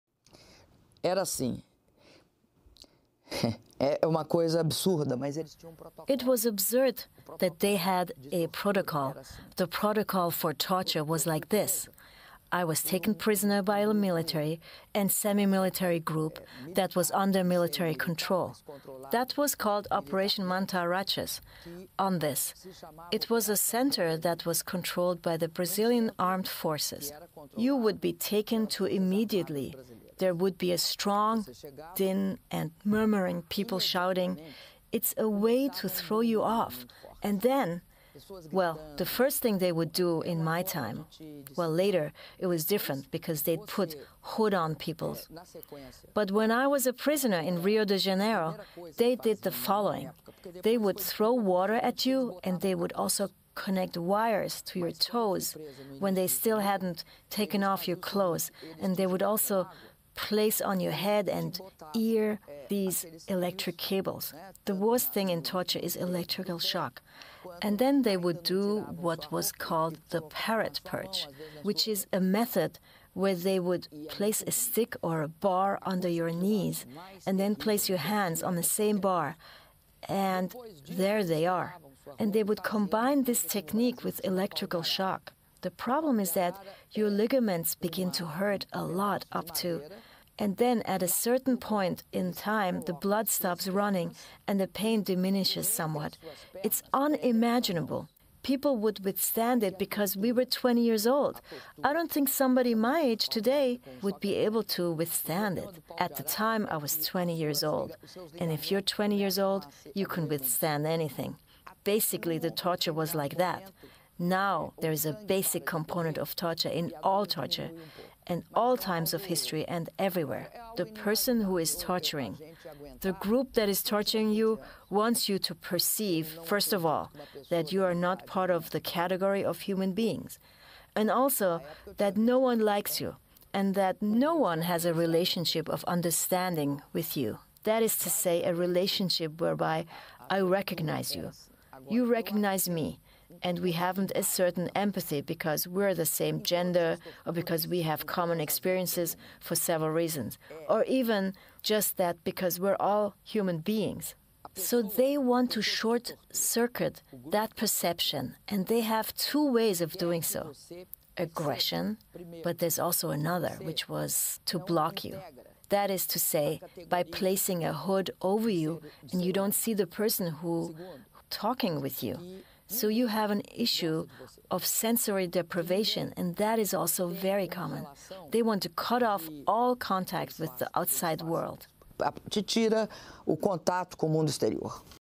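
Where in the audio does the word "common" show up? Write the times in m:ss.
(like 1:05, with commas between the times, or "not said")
2:28, 2:57.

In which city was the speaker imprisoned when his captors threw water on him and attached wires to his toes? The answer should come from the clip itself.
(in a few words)
Rio de Janeiro.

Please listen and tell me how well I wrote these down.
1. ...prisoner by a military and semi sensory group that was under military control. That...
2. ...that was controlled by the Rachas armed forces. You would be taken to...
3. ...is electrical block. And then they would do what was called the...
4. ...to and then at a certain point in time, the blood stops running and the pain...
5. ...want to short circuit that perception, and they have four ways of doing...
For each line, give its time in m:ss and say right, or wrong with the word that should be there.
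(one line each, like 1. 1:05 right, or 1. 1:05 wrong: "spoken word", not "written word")
1. 0:13 wrong: "military", not "sensory"
2. 0:24 wrong: "Brazilian", not "Rachas"
3. 1:05 wrong: "shock", not "block"
4. 1:29 right
5. 2:35 wrong: "two", not "four".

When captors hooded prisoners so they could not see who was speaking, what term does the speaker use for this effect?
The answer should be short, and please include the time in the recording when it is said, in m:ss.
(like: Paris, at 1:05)
sensory deprivation, at 2:54.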